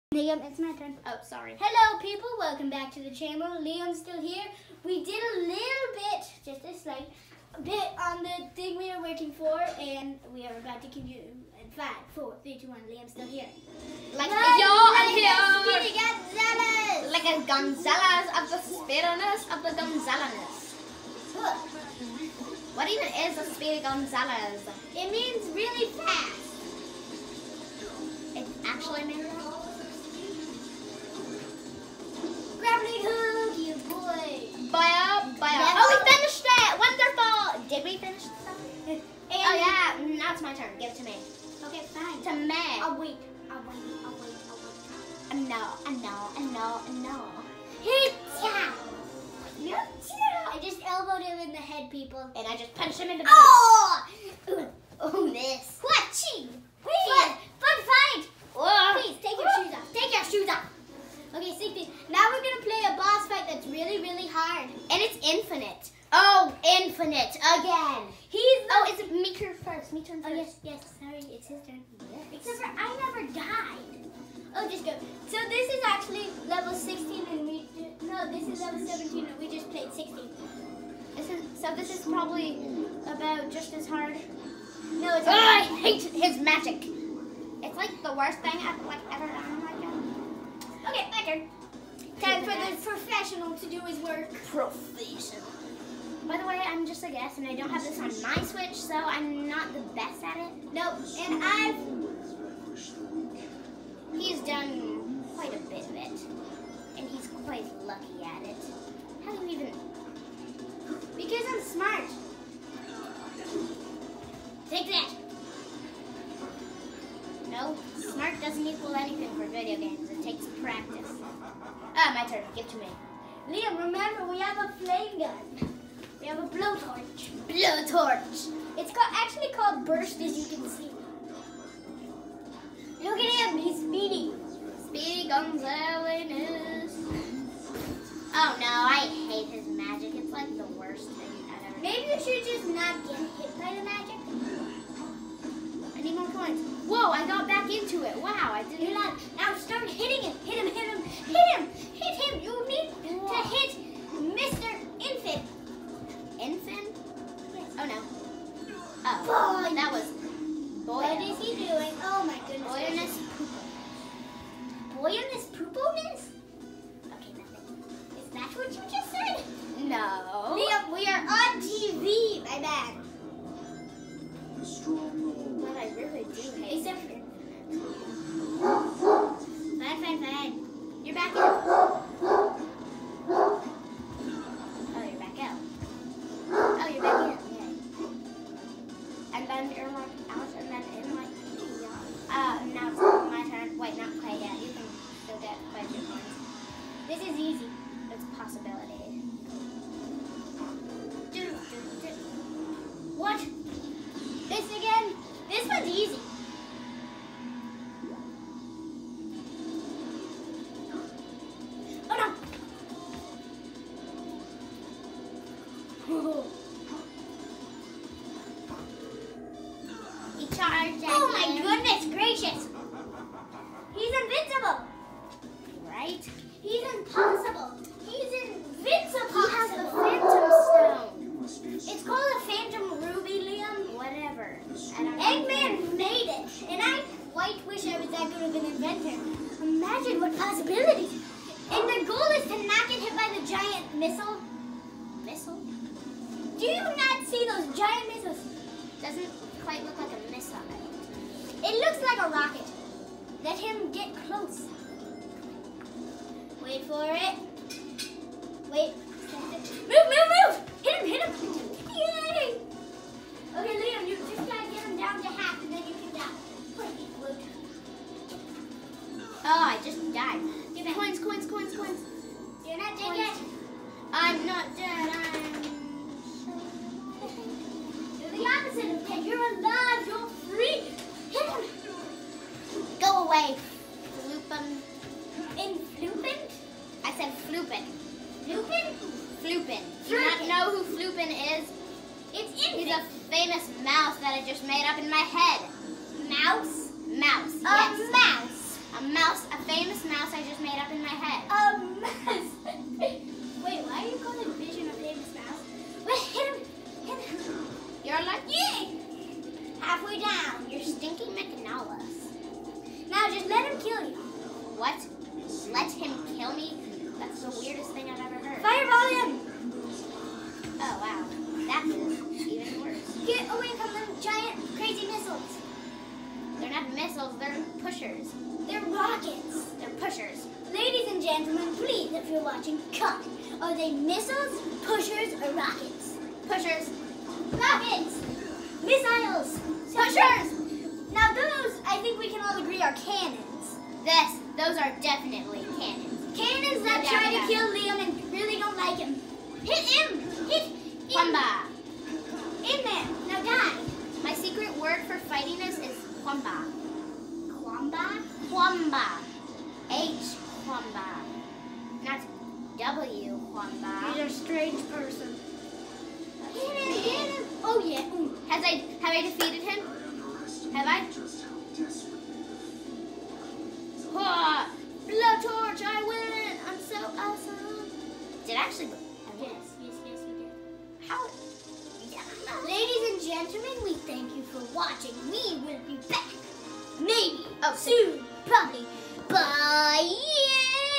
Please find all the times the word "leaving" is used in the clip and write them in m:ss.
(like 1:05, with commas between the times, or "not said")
not said.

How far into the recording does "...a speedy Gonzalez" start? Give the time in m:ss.
0:23.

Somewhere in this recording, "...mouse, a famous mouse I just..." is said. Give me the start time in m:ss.
4:59.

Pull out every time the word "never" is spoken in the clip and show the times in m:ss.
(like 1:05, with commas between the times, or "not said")
1:13.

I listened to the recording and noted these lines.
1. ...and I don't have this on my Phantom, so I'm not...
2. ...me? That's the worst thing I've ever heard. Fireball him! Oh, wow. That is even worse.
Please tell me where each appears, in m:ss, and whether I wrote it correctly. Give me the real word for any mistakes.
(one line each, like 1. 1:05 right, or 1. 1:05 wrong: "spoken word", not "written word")
1. 1:37 wrong: "Switch", not "Phantom"
2. 5:16 wrong: "weirdest", not "worst".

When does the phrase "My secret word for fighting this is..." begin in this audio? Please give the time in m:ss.
5:54.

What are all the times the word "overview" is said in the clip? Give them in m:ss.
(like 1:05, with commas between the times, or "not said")
not said.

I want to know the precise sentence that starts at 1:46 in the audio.
And he's quite lucky at it.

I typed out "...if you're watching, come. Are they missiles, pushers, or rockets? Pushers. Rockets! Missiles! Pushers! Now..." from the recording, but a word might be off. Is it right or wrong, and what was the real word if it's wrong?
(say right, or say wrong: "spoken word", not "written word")
right.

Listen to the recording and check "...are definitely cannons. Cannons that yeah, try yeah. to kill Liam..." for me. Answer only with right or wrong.
right.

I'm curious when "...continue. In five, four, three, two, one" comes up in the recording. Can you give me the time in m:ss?
0:10.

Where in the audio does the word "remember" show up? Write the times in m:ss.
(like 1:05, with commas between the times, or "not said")
2:03.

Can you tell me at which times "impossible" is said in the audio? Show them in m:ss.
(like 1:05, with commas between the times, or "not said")
3:46.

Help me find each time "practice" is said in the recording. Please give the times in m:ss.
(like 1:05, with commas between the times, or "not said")
2:00.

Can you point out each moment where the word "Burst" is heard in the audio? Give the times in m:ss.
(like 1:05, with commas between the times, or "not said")
2:09.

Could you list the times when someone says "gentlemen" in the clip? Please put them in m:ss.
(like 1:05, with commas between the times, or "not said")
5:31, 6:23.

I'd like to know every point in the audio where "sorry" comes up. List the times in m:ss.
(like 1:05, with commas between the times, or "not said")
0:01, 1:11.